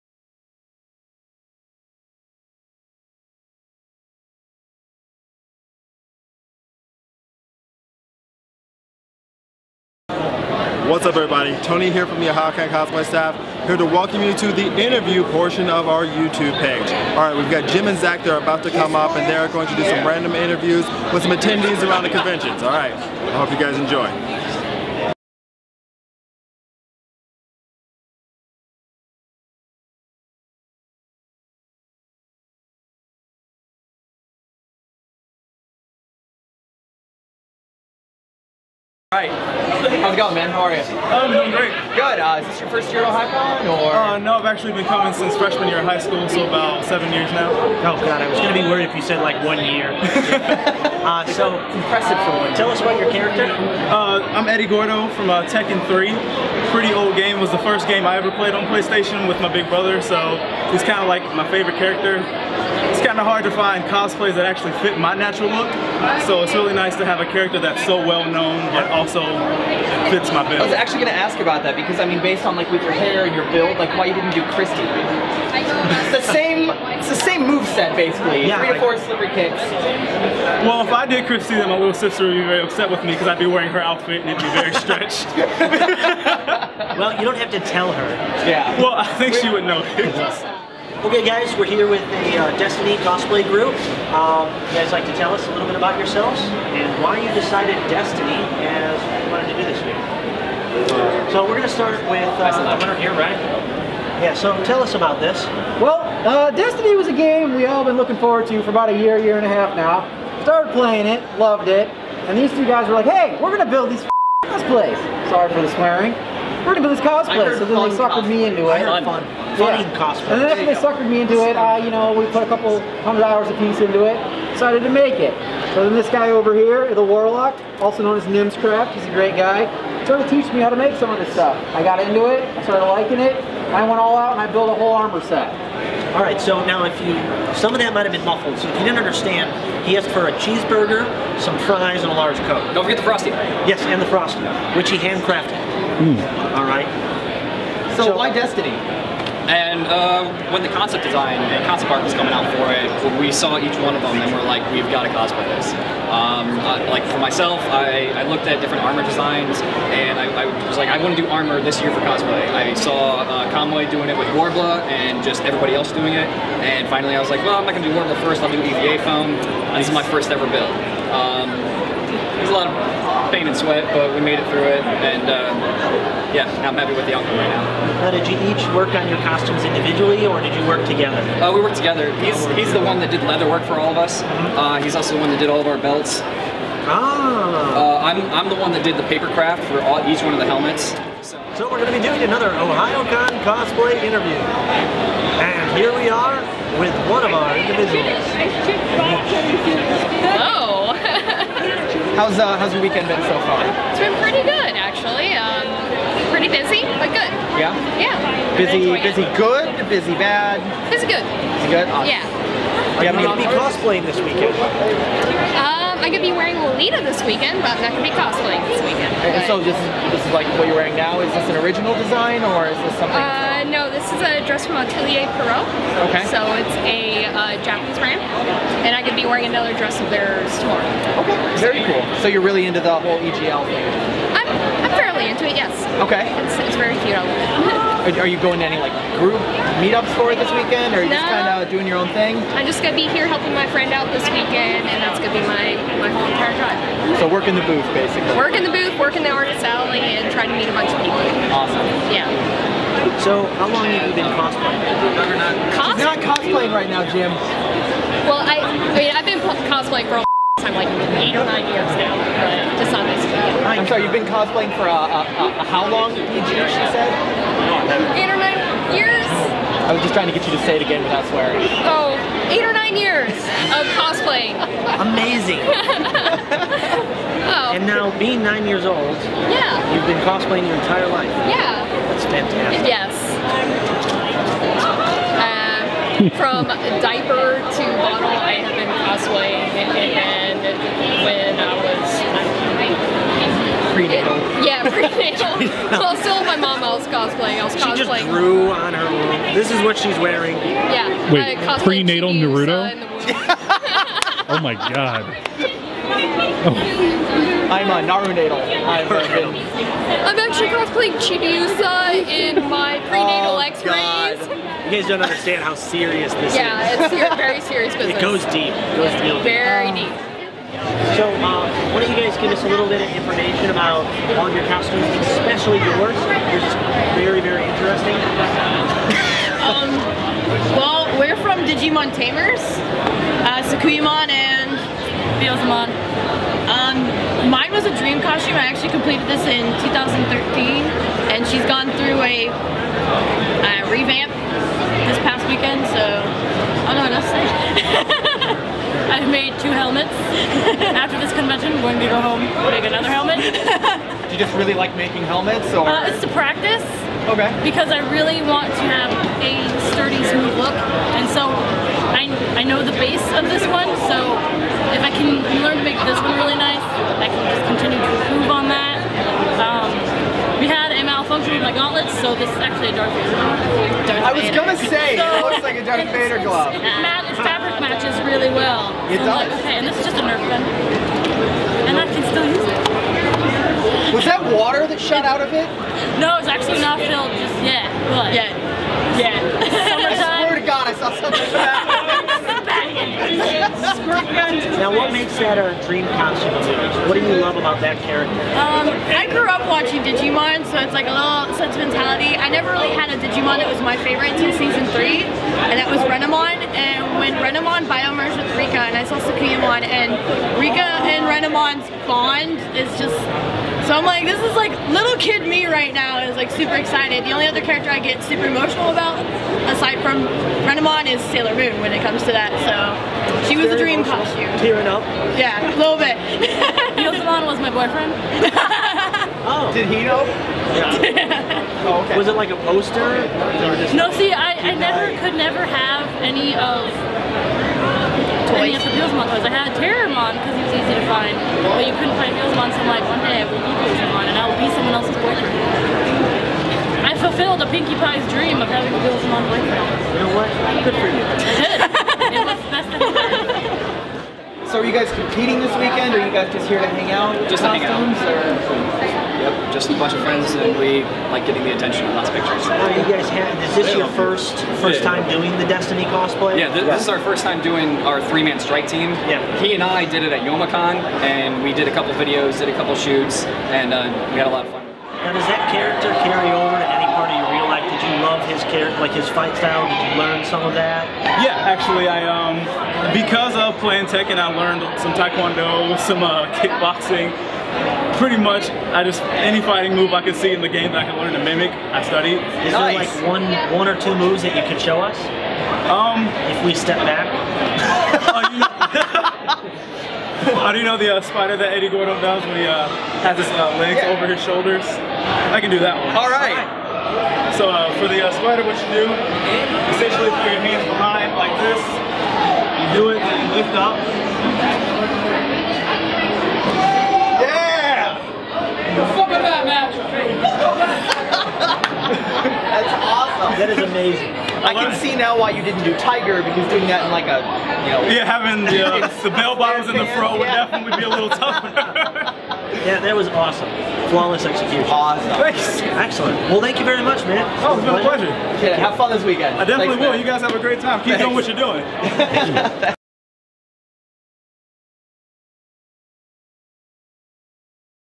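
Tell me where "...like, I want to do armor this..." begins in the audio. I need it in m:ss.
2:40.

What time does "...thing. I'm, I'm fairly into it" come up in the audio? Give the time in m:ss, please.
3:53.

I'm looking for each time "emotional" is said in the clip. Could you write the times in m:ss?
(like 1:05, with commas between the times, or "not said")
6:58, 7:03.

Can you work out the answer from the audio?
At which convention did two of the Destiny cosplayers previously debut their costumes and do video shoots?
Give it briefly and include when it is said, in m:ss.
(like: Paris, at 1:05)
Youmacon, at 7:50.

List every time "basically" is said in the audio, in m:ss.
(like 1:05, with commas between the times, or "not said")
1:17, 4:07.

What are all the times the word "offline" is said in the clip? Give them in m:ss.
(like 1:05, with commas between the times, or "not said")
not said.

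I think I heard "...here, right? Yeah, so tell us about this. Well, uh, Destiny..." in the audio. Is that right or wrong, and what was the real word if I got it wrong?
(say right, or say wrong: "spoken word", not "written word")
right.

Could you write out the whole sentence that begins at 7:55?
Now, does that character carry over to any part of your real life?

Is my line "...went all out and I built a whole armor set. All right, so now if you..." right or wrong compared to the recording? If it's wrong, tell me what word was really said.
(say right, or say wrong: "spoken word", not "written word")
right.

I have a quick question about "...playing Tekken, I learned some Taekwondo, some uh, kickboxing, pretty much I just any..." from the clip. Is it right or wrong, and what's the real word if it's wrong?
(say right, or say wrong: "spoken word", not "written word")
right.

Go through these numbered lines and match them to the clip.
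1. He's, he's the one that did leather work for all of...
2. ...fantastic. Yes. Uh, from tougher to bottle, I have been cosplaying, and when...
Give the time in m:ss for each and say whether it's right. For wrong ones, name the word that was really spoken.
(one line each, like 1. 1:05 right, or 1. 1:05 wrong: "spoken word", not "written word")
1. 3:02 right
2. 4:42 wrong: "diaper", not "tougher".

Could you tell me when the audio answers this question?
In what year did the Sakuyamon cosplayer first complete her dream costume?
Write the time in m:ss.
5:39.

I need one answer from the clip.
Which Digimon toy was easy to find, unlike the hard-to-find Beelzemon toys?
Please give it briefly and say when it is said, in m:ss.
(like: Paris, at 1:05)
Terriermon, at 7:19.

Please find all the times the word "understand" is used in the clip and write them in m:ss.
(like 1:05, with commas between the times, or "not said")
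2:18, 5:15.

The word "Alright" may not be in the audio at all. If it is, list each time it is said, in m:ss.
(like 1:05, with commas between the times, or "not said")
0:17, 0:22.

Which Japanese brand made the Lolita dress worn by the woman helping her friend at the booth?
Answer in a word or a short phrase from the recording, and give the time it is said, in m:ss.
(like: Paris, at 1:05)
Atelier Pierrot, at 3:44.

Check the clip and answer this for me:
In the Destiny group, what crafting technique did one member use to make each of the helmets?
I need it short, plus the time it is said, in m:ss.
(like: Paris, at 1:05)
Paper craft, at 3:09.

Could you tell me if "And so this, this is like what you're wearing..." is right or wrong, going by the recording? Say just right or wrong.
right.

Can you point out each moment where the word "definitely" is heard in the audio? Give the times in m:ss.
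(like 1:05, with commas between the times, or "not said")
8:50, 8:59.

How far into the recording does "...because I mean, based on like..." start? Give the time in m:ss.
1:11.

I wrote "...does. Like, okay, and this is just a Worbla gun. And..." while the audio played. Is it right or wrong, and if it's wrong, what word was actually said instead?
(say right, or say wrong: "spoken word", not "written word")
wrong: "Nerf", not "Worbla".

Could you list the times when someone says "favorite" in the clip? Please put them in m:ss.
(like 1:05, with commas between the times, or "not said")
1:01, 6:44.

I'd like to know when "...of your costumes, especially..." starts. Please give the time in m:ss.
5:24.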